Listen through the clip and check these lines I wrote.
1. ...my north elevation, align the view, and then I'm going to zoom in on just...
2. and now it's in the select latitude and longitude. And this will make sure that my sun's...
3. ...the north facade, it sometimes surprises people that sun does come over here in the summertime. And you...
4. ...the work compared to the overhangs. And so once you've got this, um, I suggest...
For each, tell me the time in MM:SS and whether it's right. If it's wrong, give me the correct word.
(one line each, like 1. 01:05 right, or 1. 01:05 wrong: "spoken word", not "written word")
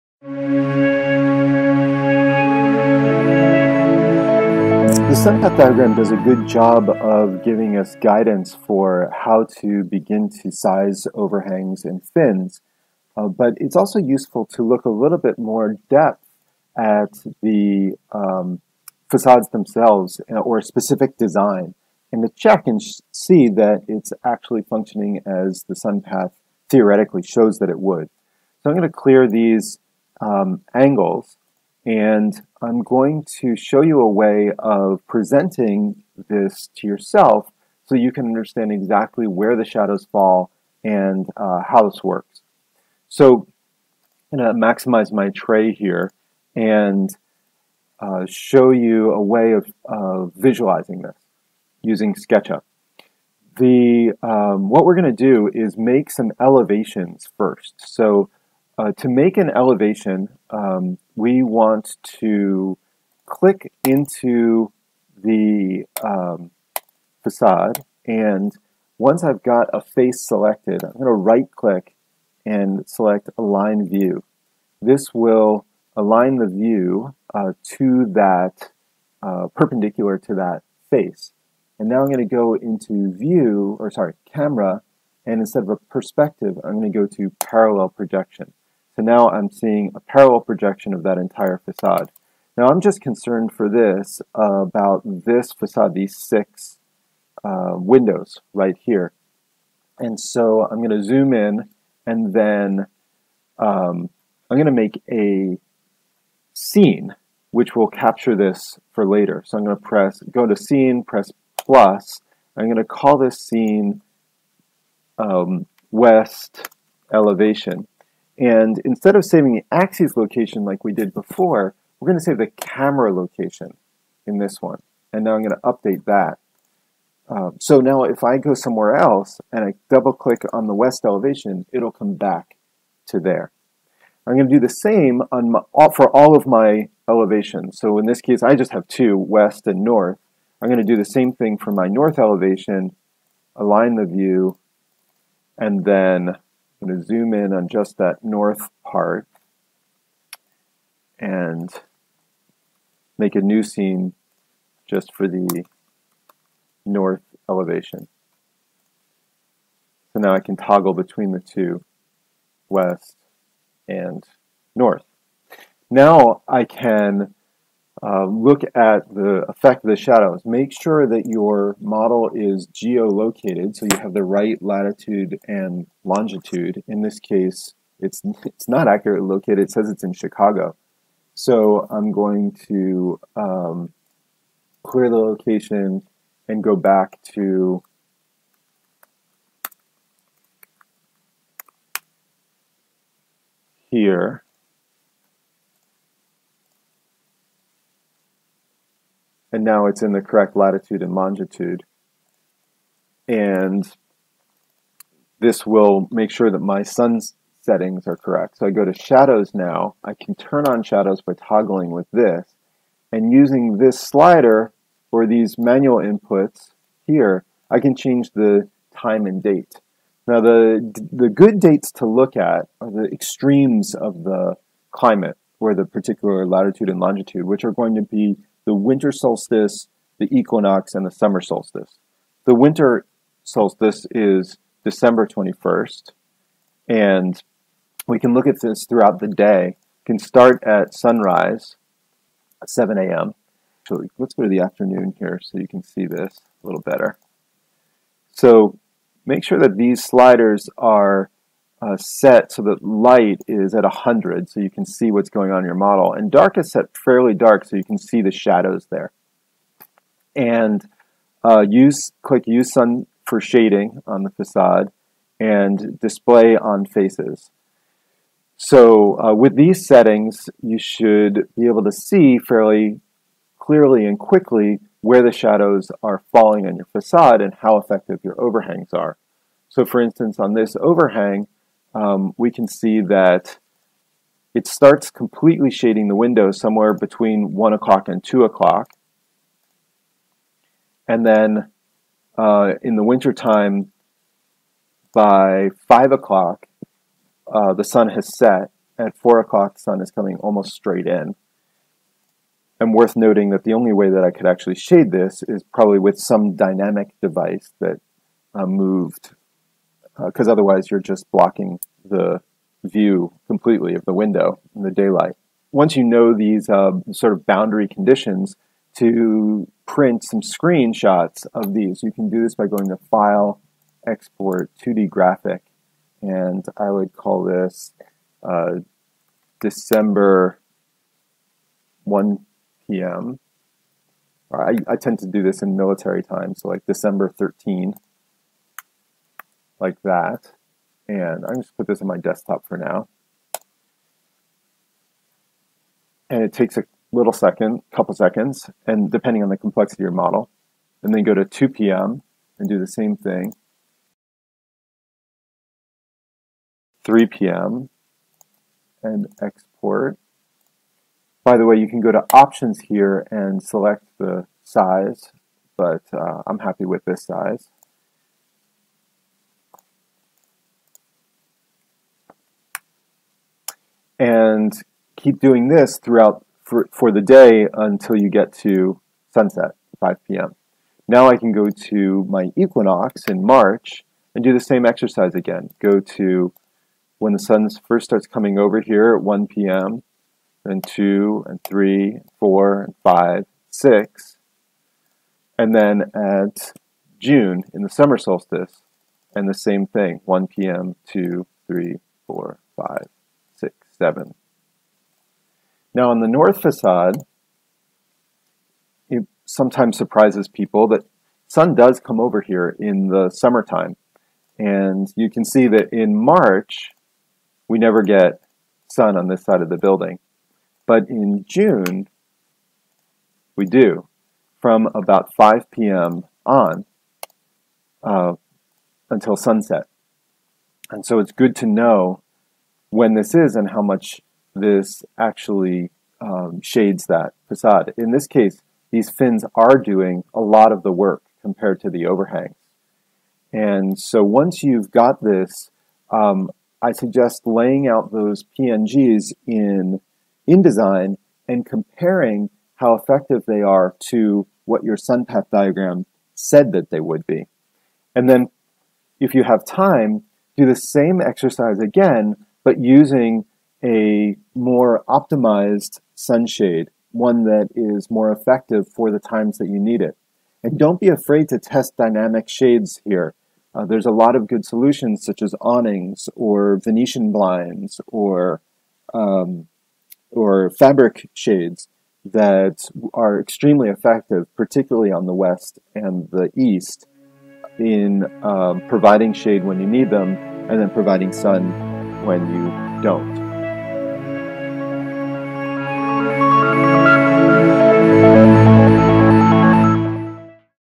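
1. 02:21 right
2. 03:19 wrong: "correct", not "select"
3. 06:46 right
4. 07:20 right.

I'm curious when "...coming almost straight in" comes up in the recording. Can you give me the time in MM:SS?
05:00.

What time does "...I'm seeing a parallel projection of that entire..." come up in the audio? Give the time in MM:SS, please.
01:29.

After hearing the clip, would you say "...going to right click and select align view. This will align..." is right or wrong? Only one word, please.
right.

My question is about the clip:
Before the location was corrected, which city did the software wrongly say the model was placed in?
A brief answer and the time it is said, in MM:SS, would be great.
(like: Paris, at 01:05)
Chicago, at 03:00.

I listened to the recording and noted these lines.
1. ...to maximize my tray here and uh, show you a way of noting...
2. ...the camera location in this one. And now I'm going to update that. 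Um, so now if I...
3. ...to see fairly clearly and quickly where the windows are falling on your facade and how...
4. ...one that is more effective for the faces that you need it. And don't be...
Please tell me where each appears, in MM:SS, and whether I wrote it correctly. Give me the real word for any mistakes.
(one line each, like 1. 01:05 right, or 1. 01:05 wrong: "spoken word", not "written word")
1. 00:44 wrong: "visualizing", not "noting"
2. 02:02 right
3. 04:31 wrong: "shadows", not "windows"
4. 07:47 wrong: "times", not "faces".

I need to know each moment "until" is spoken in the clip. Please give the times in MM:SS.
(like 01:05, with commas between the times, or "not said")
06:17, 07:09.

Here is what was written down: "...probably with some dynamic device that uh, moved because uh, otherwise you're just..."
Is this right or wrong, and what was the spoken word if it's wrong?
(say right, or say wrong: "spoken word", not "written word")
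right.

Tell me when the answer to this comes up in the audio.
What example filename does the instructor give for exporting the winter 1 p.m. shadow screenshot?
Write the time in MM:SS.
05:36.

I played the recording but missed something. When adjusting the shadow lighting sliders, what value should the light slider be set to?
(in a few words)
100.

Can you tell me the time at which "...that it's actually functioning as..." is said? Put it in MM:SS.
00:23.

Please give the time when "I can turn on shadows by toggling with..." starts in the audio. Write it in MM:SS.
03:30.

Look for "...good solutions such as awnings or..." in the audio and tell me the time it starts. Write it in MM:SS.
07:54.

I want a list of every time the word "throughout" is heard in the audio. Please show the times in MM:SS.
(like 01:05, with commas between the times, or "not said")
03:58, 06:15.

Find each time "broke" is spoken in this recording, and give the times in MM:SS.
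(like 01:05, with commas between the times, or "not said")
not said.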